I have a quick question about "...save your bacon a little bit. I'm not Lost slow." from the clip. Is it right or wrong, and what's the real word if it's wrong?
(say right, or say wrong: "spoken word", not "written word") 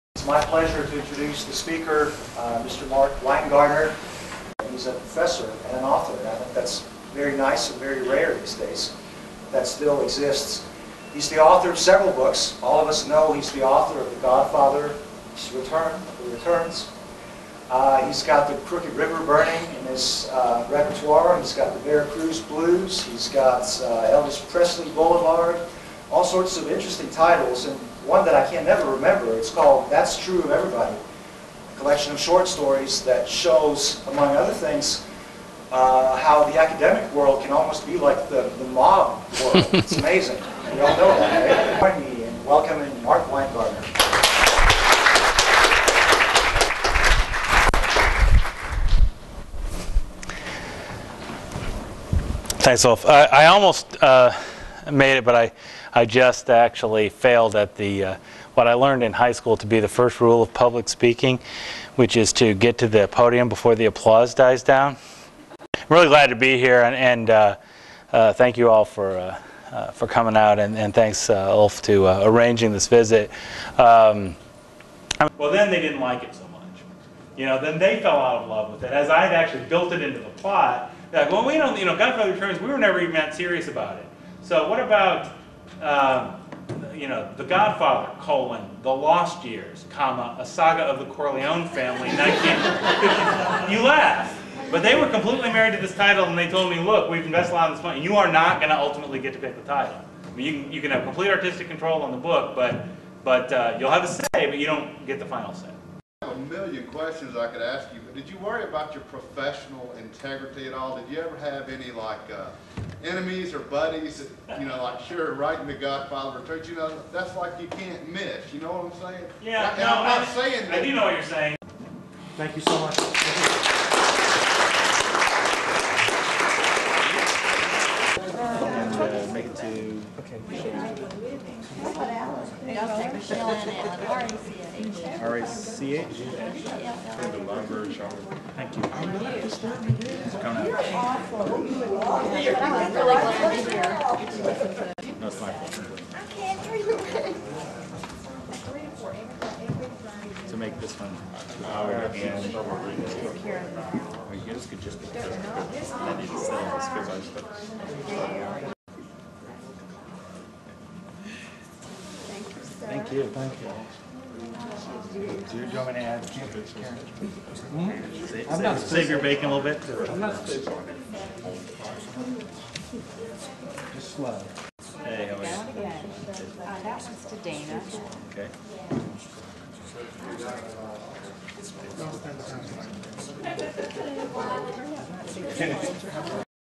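wrong: "Just", not "Lost".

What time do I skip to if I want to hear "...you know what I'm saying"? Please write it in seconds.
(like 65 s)
118 s.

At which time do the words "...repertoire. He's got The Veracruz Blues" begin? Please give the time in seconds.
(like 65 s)
20 s.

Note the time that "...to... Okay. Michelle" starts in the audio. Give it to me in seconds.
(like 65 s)
129 s.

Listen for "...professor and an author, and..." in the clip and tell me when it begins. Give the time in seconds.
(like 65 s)
4 s.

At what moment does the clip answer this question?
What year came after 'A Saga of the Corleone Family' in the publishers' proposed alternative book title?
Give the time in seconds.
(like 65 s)
92 s.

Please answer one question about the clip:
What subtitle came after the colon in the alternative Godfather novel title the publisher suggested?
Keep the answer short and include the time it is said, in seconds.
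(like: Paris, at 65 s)
The Lost Years, at 88 s.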